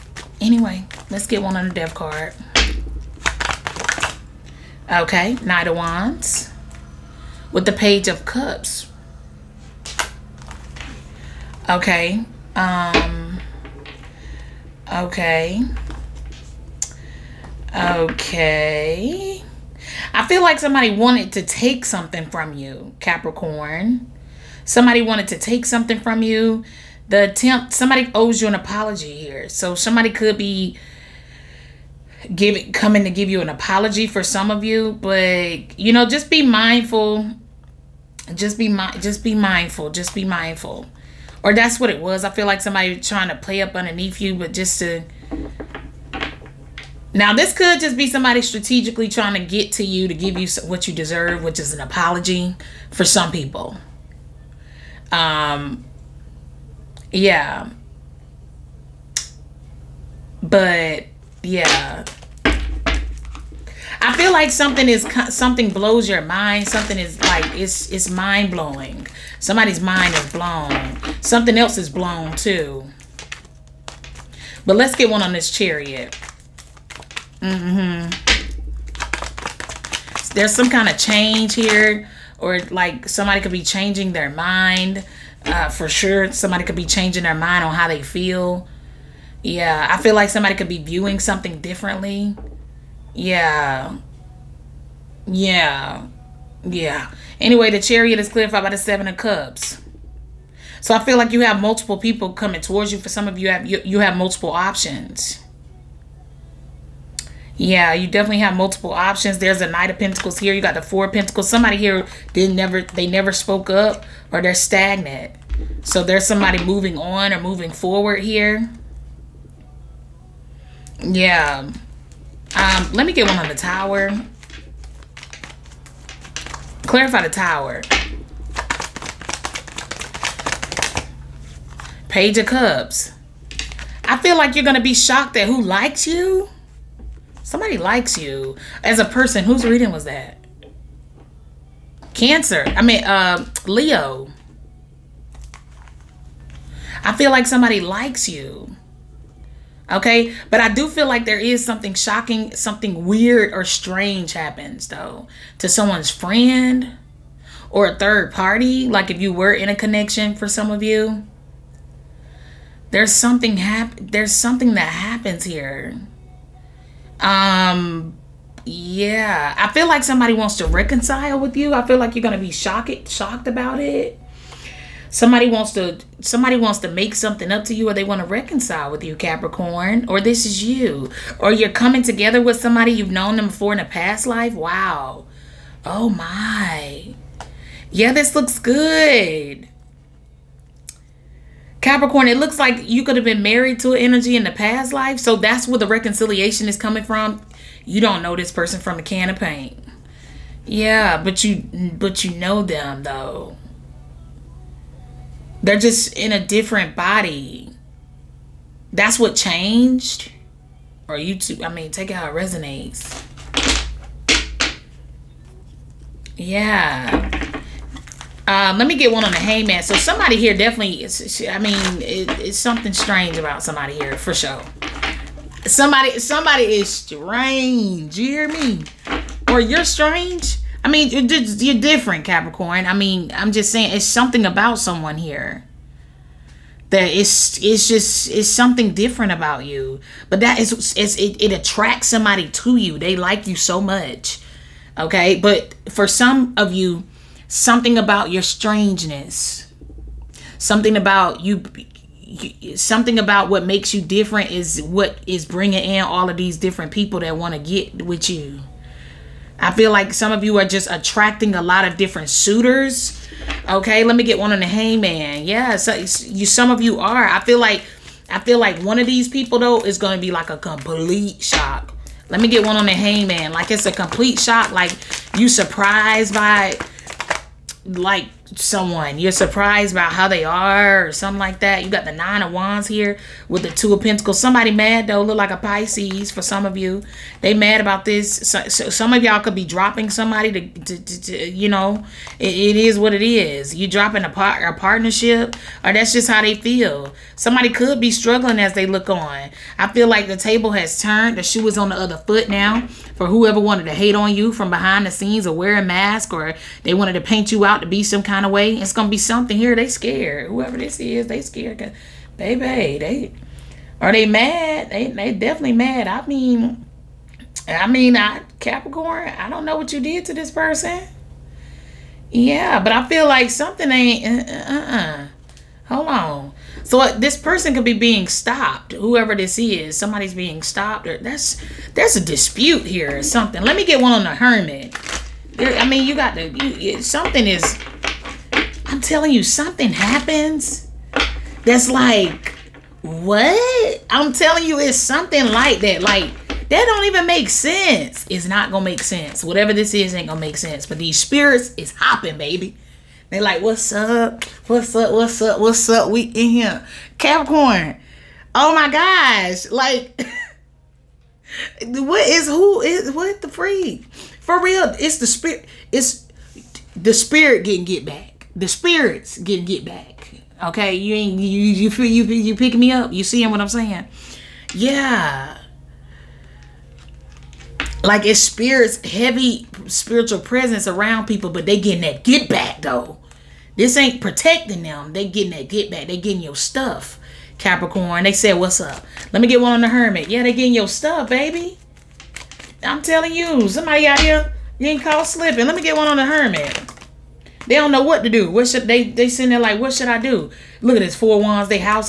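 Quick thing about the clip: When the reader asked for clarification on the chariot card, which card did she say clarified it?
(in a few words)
Seven of Cups.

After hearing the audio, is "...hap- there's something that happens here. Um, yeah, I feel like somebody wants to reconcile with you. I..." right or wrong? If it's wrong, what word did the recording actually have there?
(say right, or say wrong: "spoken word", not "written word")
right.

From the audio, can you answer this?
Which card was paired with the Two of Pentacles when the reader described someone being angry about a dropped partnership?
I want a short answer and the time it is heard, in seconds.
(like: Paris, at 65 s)
Nine of Wands, at 282 s.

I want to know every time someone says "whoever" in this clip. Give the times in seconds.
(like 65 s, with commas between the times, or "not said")
303 s, 310 s, 328 s.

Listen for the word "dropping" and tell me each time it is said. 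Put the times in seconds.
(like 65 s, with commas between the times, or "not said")
289 s, 293 s.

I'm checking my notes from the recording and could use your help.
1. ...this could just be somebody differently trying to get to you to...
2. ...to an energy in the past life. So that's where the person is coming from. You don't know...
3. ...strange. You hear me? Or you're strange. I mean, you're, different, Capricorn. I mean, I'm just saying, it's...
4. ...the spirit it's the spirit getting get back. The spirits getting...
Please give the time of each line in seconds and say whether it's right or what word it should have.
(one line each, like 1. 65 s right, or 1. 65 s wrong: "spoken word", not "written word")
1. 47 s wrong: "strategically", not "differently"
2. 193 s wrong: "reconciliation", not "person"
3. 226 s right
4. 365 s right.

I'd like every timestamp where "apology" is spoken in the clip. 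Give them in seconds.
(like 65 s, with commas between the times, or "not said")
28 s, 33 s, 51 s.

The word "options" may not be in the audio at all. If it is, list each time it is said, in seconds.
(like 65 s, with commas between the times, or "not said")
104 s, 108 s.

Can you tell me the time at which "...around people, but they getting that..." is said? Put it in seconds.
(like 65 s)
380 s.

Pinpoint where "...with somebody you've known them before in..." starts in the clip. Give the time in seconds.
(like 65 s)
182 s.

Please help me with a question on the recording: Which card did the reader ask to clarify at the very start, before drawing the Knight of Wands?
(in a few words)
Death card.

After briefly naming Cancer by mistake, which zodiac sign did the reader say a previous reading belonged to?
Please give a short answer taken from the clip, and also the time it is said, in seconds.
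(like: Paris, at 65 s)
Leo, at 143 s.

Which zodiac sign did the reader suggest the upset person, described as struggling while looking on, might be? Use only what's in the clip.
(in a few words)
Pisces.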